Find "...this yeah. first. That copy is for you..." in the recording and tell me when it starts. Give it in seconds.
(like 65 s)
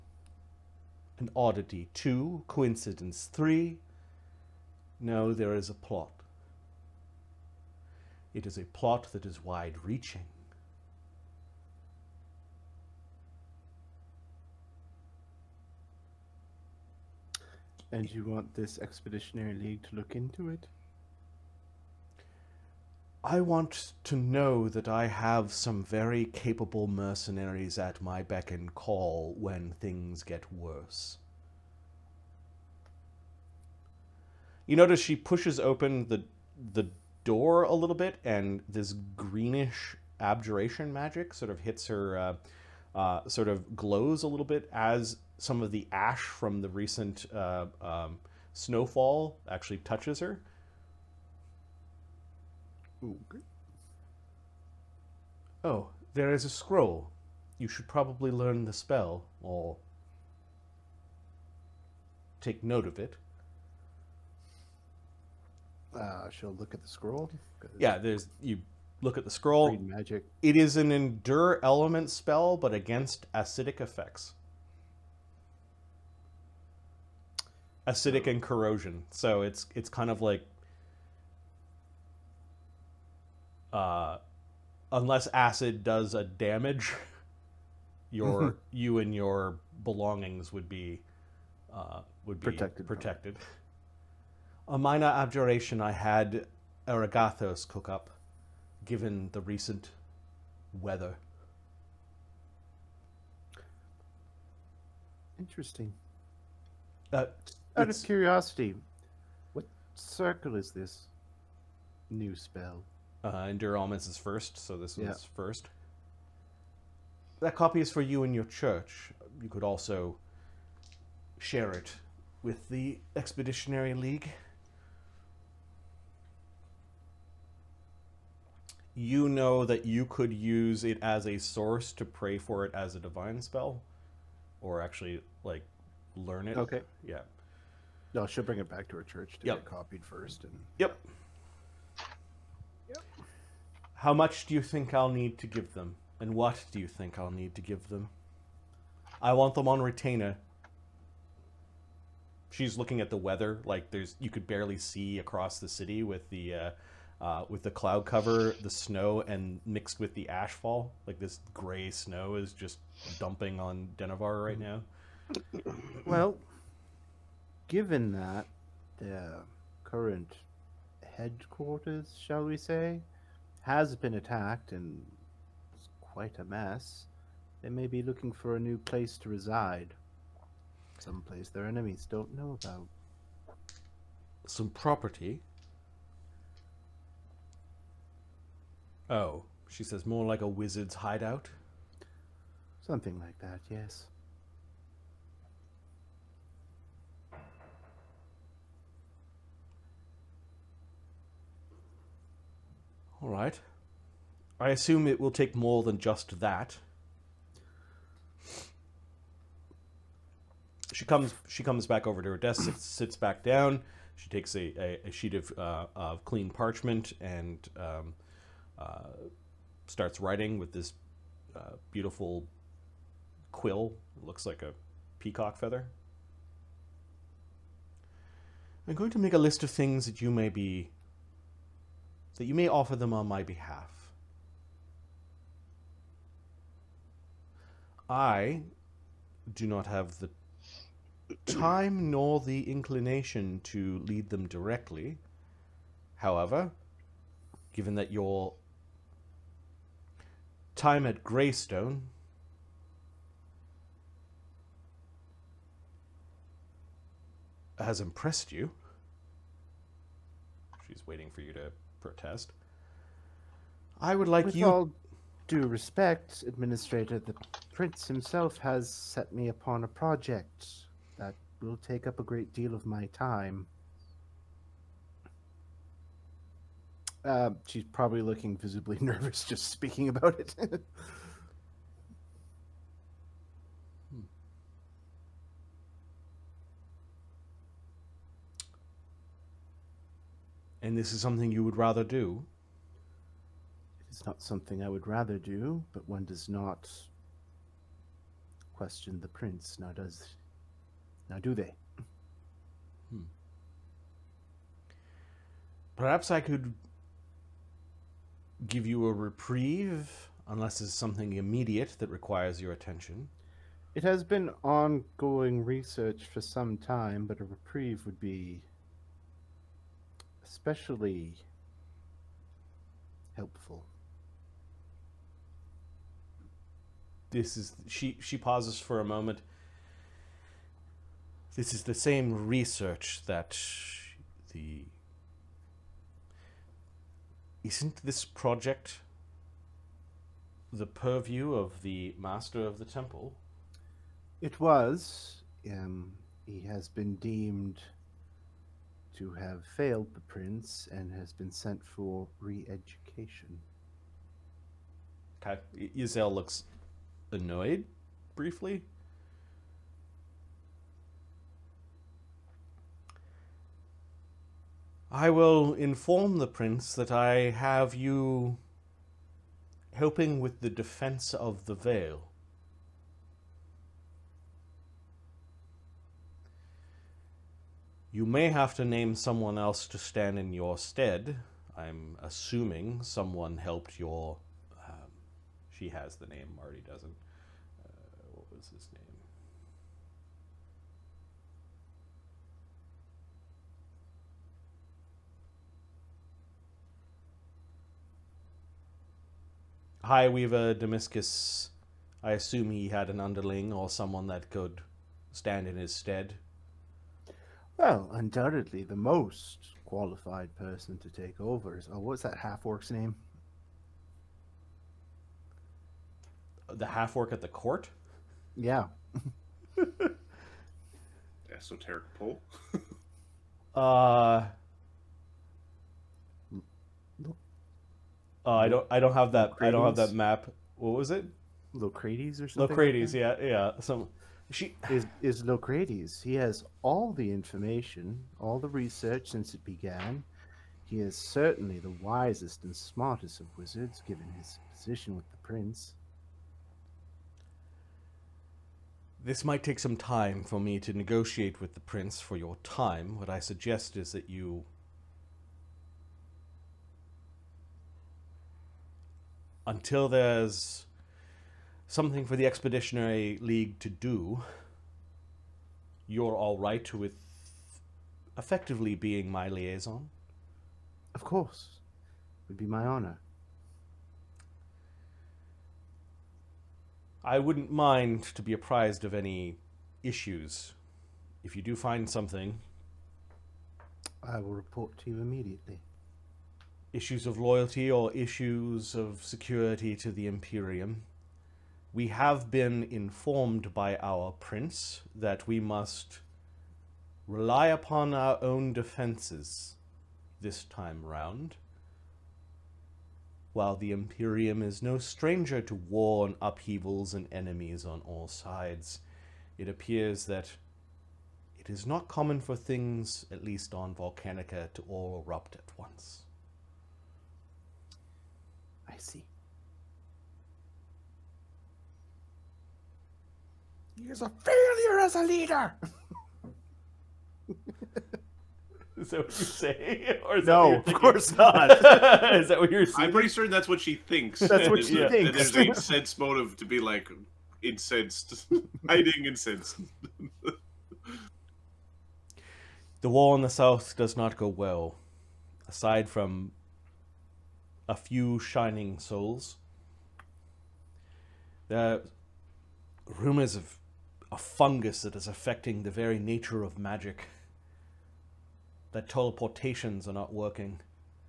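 114 s.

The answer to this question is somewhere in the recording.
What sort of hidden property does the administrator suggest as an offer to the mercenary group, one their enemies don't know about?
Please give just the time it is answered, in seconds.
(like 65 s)
190 s.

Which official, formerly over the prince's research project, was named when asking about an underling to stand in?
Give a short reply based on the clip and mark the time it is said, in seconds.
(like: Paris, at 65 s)
High Weaver Demiscus, at 400 s.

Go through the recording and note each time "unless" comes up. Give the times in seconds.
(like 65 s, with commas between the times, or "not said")
84 s, 310 s.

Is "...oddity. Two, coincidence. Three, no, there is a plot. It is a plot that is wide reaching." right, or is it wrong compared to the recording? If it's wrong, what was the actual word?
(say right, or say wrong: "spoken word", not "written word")
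right.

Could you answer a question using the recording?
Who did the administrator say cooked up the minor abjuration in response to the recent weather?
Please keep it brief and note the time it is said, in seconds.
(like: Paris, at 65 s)
Aragathos, at 96 s.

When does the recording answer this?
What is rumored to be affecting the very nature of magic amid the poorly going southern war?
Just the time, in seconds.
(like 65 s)
554 s.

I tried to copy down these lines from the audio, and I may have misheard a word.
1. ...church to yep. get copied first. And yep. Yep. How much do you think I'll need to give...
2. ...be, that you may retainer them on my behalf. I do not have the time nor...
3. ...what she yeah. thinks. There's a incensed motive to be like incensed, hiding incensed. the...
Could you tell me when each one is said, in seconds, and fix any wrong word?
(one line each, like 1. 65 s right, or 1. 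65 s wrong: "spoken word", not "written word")
1. 139 s right
2. 230 s wrong: "offer", not "retainer"
3. 534 s right.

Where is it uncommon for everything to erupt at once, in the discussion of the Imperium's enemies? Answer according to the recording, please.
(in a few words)
Volcanica.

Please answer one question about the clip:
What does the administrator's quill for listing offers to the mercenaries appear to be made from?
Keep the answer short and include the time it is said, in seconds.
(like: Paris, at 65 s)
a peacock feather, at 225 s.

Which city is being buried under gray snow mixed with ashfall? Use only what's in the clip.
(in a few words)
Denivar.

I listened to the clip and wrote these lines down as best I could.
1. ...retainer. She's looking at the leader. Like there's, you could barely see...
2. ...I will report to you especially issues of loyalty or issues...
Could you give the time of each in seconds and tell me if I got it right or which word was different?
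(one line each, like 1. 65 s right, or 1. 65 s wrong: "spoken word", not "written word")
1. 149 s wrong: "weather", not "leader"
2. 484 s wrong: "immediately", not "especially".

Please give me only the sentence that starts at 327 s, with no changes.
This is she she pauses for a moment.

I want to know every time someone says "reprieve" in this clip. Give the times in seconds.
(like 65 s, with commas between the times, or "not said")
309 s, 317 s.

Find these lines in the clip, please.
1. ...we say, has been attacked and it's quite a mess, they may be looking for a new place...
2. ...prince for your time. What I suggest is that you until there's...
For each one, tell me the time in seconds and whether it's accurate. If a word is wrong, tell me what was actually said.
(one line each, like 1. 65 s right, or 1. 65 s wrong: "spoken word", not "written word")
1. 172 s right
2. 451 s right.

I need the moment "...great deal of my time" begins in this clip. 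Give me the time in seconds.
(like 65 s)
272 s.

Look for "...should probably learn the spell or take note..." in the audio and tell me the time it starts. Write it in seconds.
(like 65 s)
57 s.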